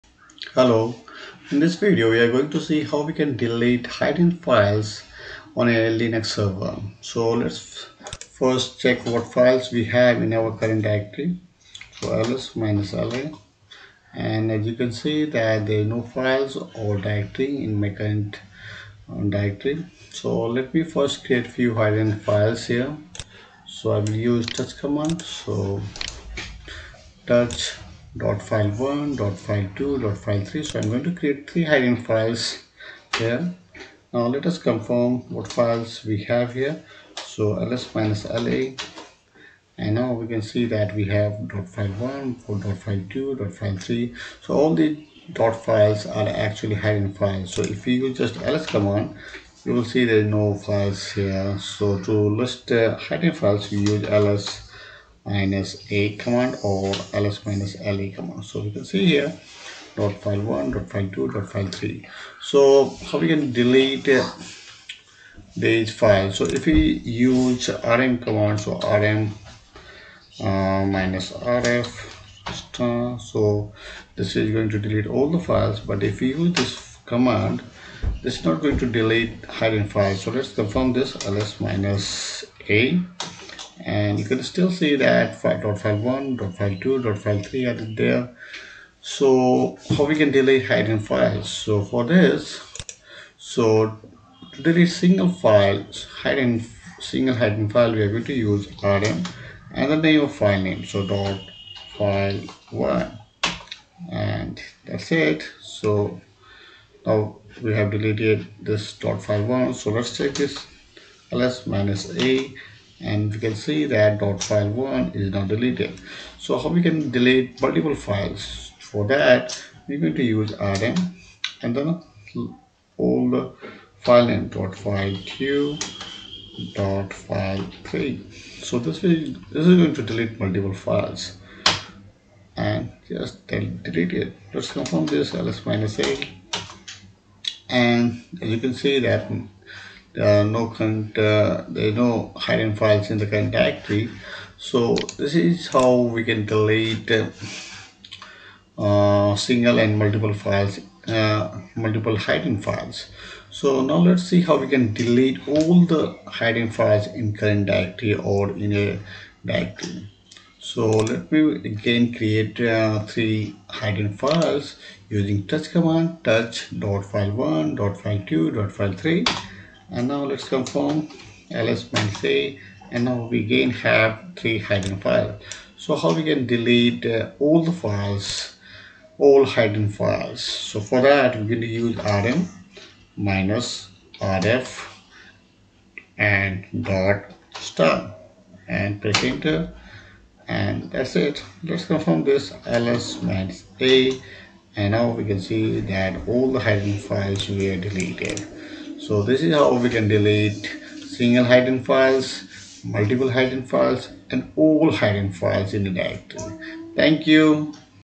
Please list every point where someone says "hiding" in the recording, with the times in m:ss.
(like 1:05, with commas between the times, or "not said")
0:31, 0:46, 0:52.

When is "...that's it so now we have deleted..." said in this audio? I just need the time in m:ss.
1:44.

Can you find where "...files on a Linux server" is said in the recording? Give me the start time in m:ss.
0:04.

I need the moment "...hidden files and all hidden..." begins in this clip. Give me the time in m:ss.
3:23.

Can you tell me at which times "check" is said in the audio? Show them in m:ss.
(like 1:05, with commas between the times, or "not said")
0:08, 1:50.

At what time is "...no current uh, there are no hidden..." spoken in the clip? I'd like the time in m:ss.
2:20.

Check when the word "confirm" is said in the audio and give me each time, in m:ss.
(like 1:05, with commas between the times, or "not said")
0:34, 1:20, 2:14, 2:50, 3:11.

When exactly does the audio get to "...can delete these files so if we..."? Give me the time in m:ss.
1:03.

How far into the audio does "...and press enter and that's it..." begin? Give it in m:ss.
3:08.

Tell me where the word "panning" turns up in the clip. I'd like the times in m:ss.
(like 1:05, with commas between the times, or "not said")
not said.